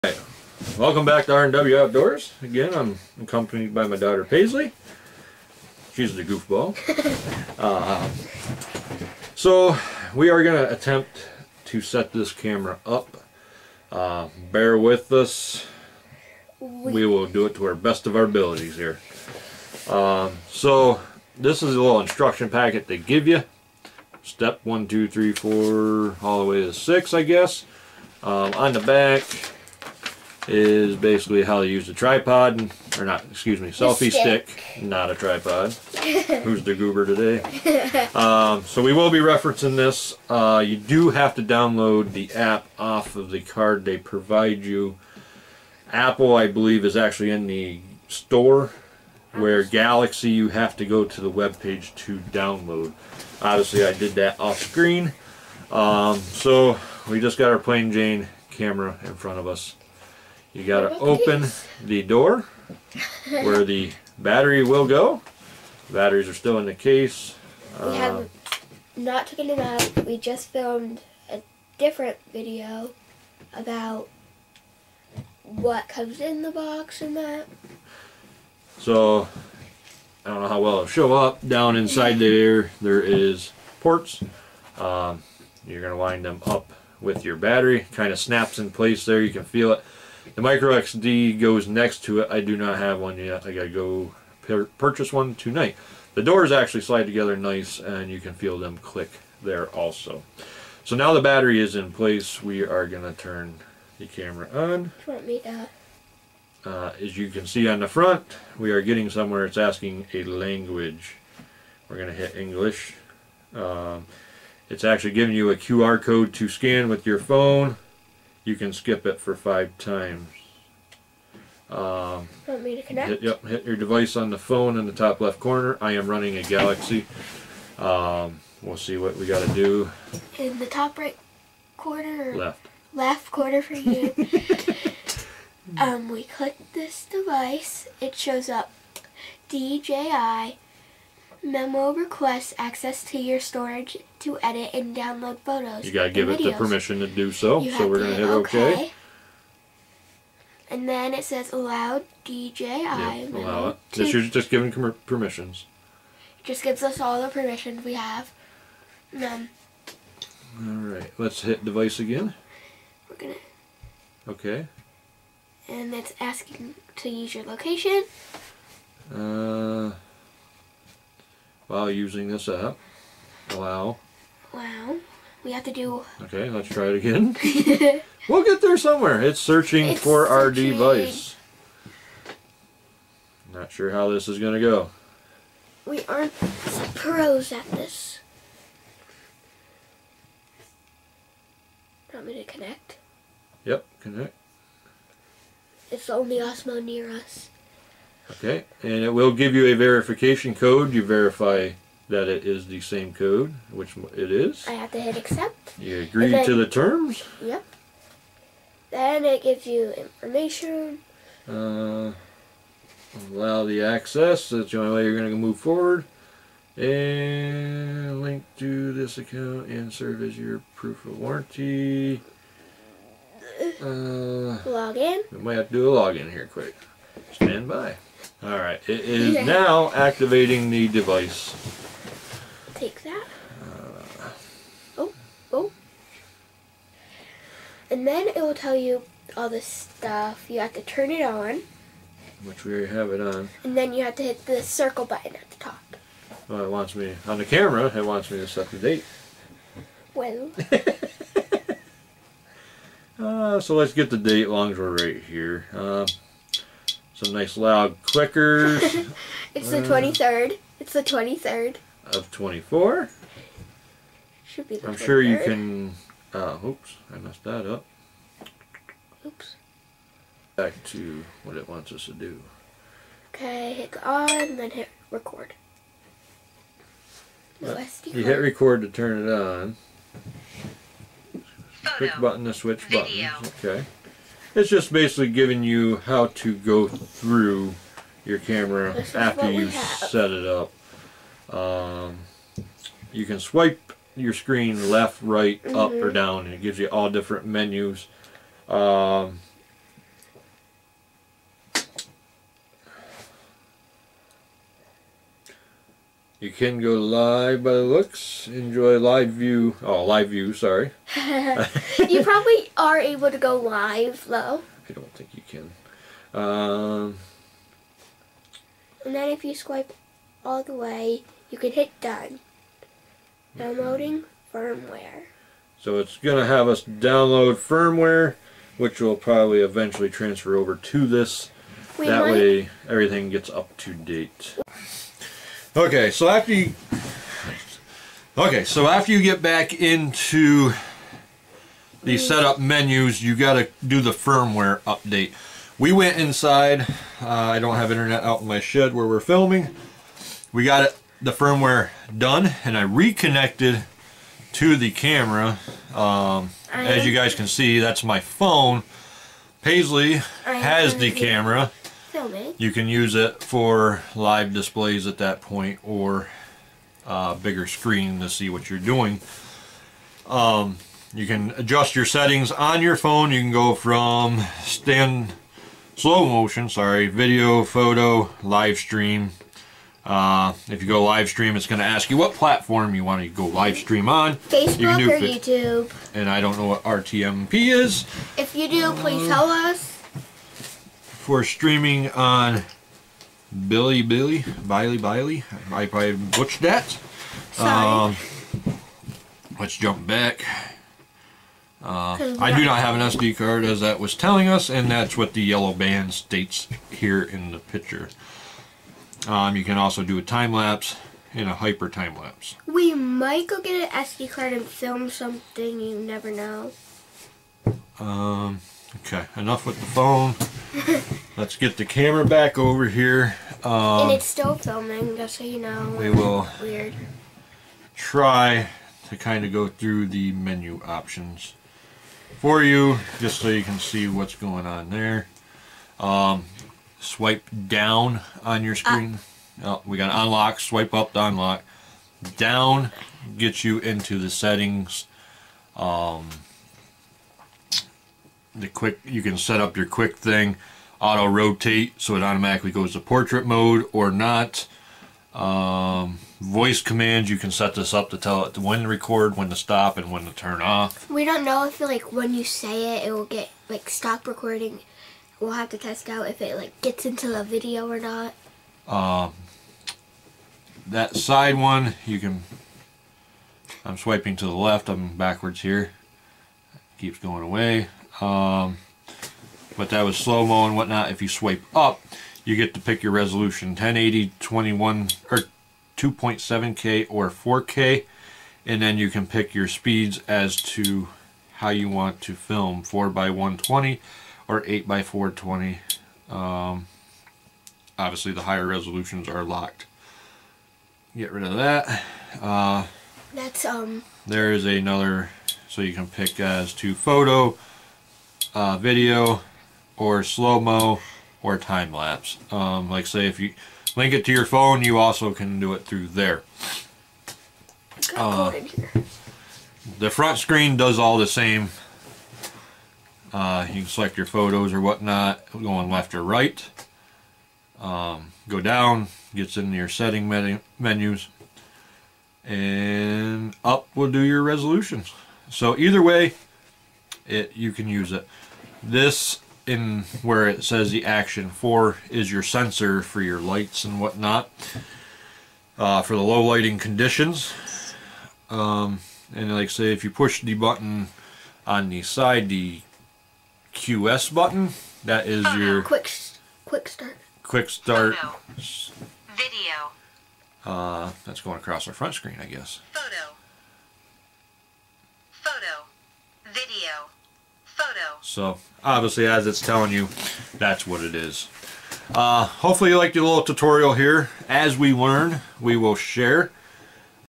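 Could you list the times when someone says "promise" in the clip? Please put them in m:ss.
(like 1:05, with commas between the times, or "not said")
not said.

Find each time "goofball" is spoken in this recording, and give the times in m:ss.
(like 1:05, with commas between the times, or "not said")
0:06.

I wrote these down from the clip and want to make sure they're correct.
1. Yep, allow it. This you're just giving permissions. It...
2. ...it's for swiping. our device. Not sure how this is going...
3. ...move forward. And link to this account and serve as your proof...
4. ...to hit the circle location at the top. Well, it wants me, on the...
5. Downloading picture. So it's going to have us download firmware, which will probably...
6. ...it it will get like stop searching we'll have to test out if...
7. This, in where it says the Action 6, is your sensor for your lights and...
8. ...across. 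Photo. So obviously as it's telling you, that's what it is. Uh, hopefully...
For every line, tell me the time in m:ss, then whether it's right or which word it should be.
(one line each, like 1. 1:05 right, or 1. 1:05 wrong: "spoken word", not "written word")
1. 2:32 right
2. 2:59 wrong: "searching", not "swiping"
3. 3:35 right
4. 4:04 wrong: "button", not "location"
5. 5:23 wrong: "firmware", not "picture"
6. 7:42 wrong: "recording", not "searching"
7. 8:58 wrong: "4", not "6"
8. 9:22 wrong: "guess", not "across".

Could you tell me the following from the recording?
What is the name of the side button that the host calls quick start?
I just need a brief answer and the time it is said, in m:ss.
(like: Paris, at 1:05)
QS button, at 9:12.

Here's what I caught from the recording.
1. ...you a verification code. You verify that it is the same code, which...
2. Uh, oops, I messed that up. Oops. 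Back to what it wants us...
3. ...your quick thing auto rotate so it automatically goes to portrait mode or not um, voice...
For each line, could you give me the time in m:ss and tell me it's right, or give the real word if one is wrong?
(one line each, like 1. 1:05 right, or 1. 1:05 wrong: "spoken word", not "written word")
1. 3:19 right
2. 4:26 right
3. 7:29 right.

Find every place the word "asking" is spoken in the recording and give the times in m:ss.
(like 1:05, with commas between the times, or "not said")
1:49, 2:46.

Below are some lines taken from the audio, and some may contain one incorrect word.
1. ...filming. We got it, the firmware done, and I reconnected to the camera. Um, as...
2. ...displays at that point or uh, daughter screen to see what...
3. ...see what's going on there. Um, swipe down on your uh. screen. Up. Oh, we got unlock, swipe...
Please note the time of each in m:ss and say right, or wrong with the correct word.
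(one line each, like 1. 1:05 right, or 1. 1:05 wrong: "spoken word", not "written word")
1. 5:49 right
2. 6:04 wrong: "bigger", not "daughter"
3. 7:13 right.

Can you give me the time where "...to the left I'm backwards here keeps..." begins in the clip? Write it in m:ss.
7:54.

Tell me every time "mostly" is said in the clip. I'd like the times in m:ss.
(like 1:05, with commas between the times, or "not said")
not said.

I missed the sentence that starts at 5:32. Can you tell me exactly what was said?
way everything gets up to date.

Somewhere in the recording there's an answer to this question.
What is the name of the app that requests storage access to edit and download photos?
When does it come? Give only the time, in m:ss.
2:19.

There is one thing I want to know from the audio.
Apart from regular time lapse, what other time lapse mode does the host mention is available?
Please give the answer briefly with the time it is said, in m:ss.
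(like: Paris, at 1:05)
hyper time lapse, at 6:51.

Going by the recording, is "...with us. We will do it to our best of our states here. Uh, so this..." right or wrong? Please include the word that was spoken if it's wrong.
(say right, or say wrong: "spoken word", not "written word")
wrong: "abilities", not "states".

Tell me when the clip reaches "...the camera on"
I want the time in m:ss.
1:43.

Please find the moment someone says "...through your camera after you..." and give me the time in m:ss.
4:46.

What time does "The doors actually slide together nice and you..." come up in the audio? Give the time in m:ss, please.
1:36.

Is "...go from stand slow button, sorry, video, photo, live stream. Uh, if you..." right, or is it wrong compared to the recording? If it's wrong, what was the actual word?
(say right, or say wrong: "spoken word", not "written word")
wrong: "motion", not "button".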